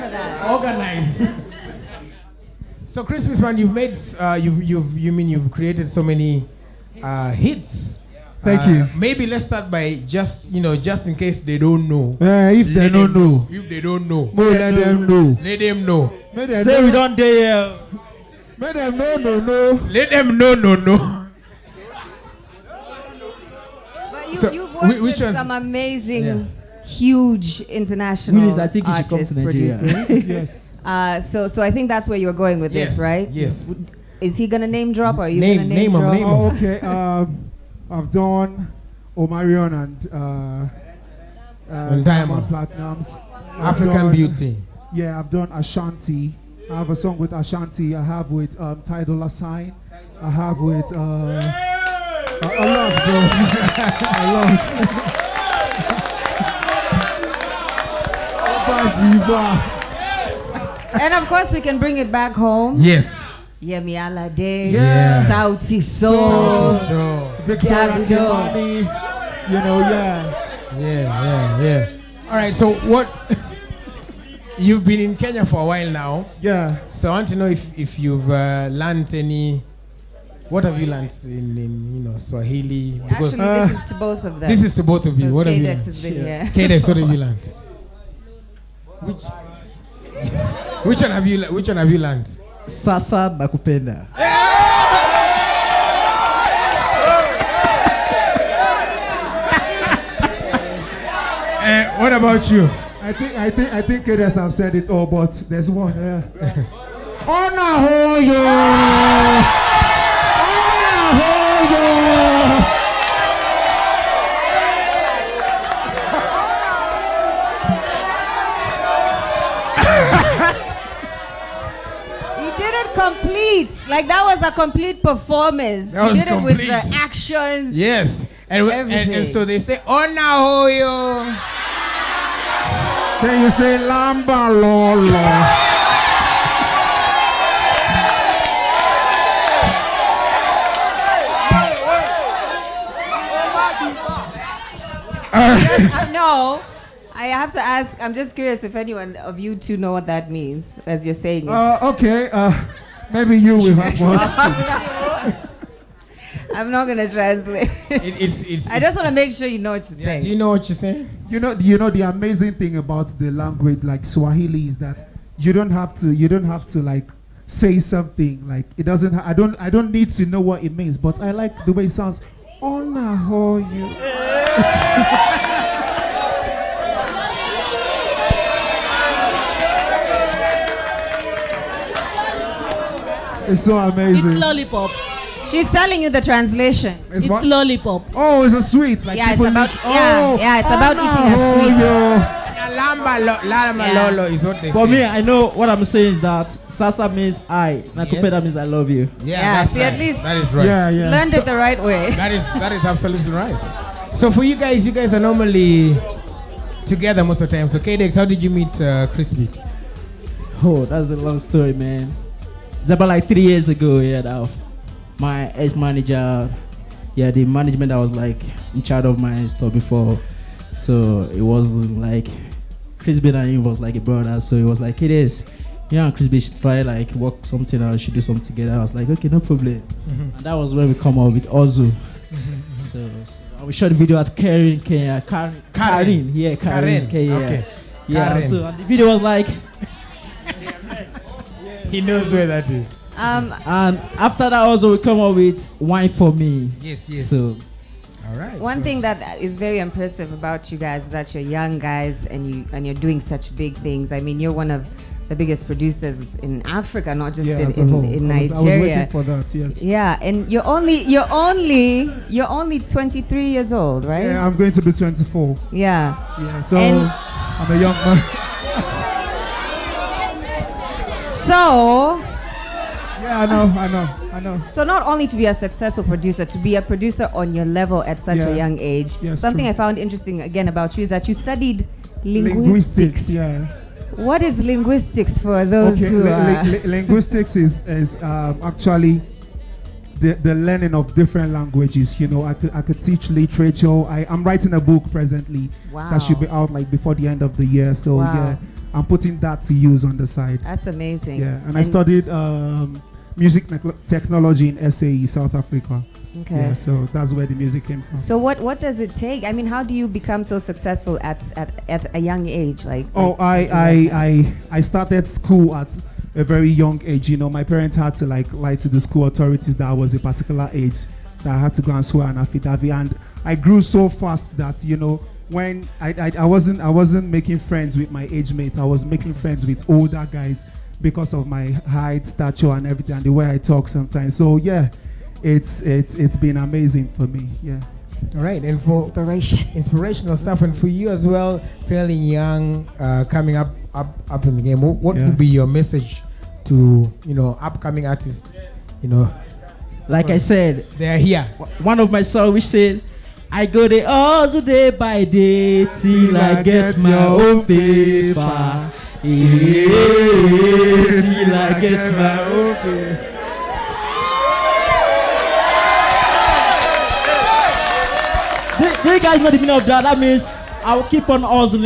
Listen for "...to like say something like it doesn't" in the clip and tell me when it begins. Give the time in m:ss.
2:46.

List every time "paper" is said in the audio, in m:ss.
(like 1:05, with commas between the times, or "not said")
5:57.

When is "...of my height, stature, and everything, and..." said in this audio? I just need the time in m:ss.
5:31.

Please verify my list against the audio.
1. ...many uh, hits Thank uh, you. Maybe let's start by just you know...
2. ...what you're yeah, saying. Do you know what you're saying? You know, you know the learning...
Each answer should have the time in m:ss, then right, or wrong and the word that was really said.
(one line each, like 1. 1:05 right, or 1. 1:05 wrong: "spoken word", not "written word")
1. 0:06 right
2. 2:39 wrong: "amazing", not "learning".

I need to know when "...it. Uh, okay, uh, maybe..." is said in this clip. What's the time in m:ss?
2:31.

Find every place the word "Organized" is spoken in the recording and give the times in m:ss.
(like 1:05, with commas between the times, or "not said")
0:00.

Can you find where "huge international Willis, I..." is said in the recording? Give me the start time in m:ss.
0:26.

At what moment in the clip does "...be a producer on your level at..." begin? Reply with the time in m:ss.
4:36.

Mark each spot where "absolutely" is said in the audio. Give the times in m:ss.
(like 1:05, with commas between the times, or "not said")
3:22.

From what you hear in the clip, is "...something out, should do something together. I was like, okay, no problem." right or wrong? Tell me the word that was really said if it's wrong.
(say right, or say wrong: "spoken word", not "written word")
right.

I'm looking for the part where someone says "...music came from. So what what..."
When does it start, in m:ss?
5:07.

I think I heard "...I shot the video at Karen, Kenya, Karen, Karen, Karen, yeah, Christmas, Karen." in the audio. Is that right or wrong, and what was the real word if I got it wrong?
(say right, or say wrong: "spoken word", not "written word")
wrong: "Karen", not "Christmas".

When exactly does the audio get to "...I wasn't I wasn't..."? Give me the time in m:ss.
5:26.